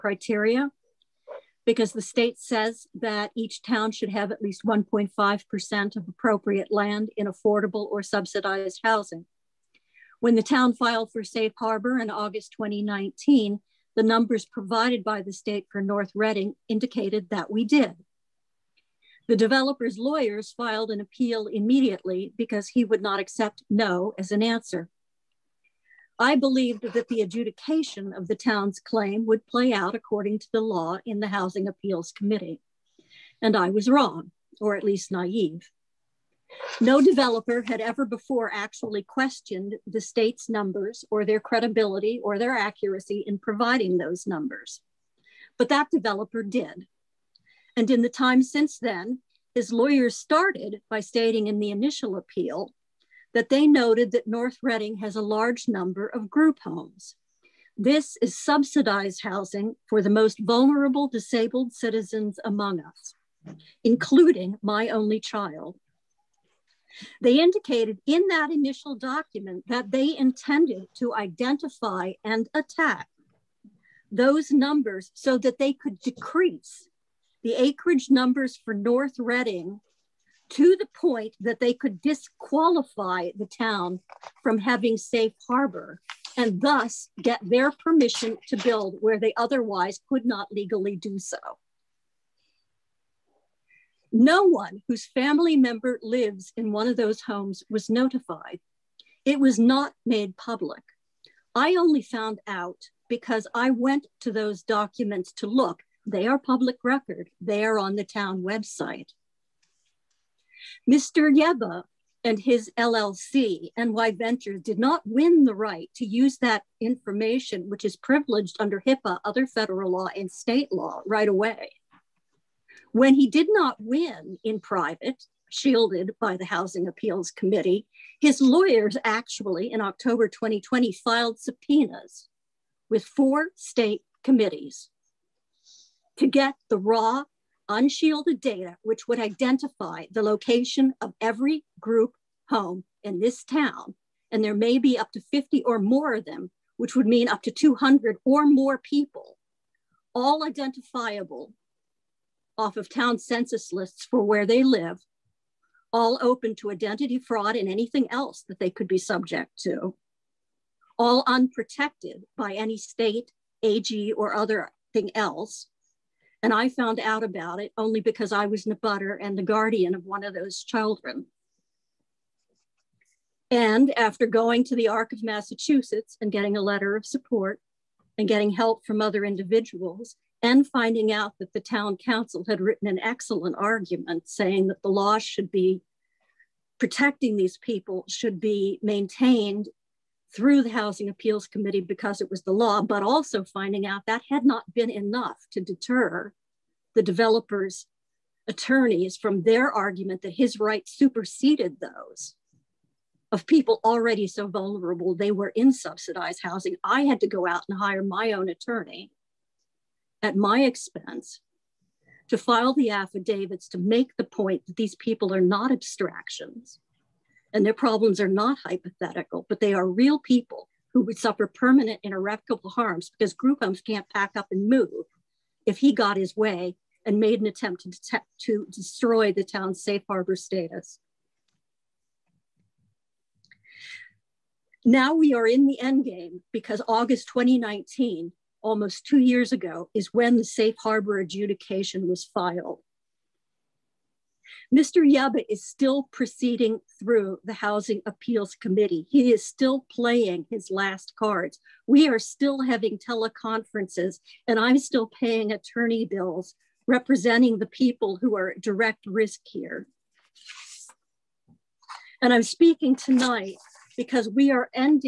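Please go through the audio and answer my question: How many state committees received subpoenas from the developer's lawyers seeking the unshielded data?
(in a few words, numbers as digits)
4.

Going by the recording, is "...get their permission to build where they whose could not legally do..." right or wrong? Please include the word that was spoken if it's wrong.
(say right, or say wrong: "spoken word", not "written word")
wrong: "otherwise", not "whose".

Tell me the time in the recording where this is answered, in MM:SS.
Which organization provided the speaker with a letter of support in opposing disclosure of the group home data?
02:54.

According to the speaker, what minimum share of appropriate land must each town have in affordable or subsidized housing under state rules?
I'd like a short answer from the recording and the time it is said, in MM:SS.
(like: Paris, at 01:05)
1.5%, at 00:04.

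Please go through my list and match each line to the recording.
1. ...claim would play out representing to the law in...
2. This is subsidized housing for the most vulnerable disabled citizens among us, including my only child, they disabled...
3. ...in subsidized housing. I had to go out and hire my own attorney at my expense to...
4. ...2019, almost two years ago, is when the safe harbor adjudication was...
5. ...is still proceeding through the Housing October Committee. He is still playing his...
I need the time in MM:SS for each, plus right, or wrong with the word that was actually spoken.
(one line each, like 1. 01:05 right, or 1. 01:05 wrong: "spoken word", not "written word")
1. 00:28 wrong: "according", not "representing"
2. 00:57 wrong: "indicated", not "disabled"
3. 03:25 right
4. 03:57 right
5. 04:05 wrong: "Appeals", not "October".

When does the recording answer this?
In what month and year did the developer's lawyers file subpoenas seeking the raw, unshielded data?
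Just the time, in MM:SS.
02:09.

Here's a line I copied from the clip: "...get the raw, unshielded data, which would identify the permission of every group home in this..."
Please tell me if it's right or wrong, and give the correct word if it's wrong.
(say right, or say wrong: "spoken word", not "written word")
wrong: "location", not "permission".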